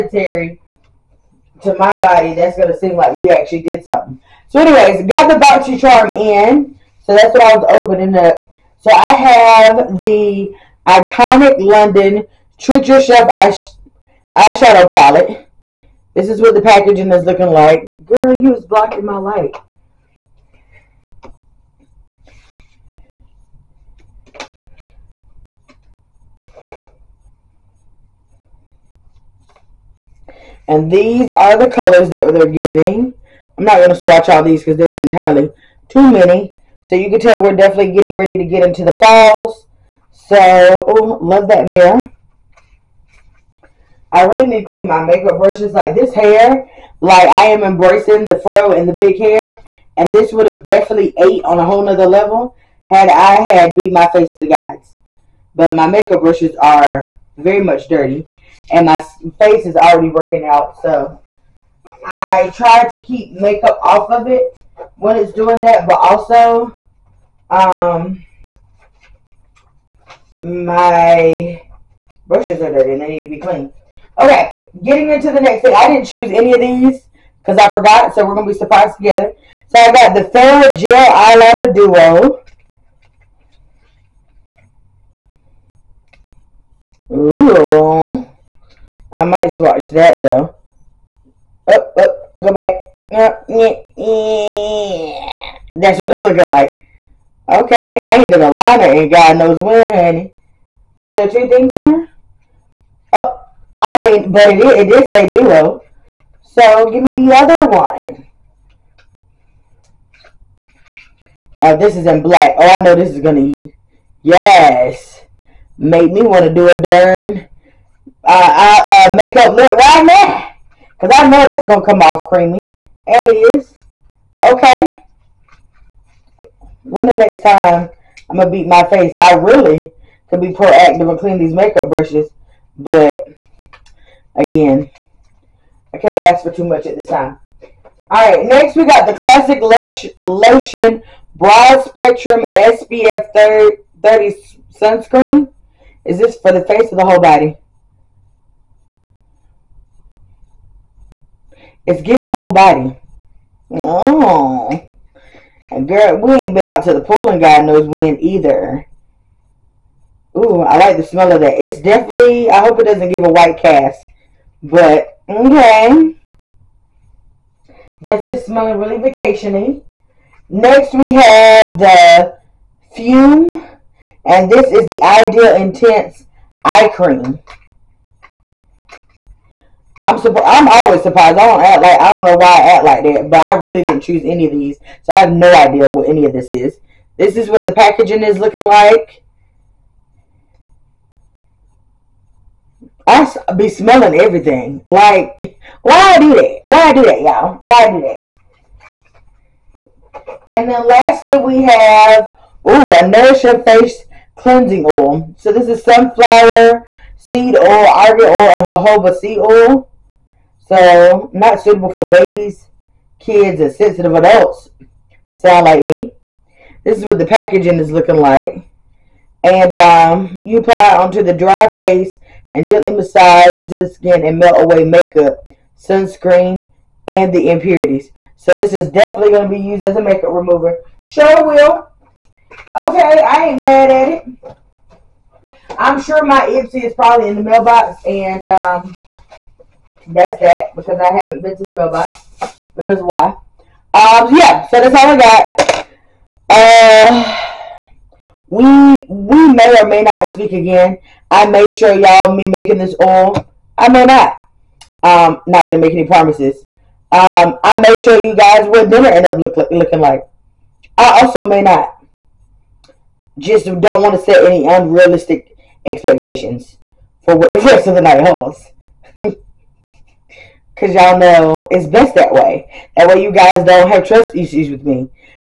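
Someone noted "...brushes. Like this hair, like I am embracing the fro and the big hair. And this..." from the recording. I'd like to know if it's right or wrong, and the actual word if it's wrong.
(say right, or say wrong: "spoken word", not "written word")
right.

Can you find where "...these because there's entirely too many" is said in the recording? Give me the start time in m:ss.
0:34.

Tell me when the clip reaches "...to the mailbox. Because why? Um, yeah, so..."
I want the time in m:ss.
4:01.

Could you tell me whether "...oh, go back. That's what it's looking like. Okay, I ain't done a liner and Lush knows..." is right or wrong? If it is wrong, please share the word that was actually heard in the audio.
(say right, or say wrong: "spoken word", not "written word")
wrong: "God", not "Lush".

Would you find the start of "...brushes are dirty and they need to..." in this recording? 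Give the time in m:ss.
1:12.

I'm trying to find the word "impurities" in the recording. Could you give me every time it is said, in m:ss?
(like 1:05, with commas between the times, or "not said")
3:47.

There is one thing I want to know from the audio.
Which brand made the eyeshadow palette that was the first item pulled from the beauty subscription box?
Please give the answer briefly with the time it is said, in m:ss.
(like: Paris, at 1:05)
Iconic London, at 0:10.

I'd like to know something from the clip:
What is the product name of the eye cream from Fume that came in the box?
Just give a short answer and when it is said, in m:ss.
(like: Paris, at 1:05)
Ideal Intense Eye Cream, at 2:55.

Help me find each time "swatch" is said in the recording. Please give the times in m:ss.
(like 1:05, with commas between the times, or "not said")
0:33, 1:29.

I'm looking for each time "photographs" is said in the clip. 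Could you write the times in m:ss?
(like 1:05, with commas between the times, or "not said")
not said.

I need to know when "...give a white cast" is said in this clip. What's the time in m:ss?
2:43.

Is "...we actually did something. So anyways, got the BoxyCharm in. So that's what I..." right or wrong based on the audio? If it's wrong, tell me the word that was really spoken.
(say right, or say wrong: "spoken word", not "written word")
right.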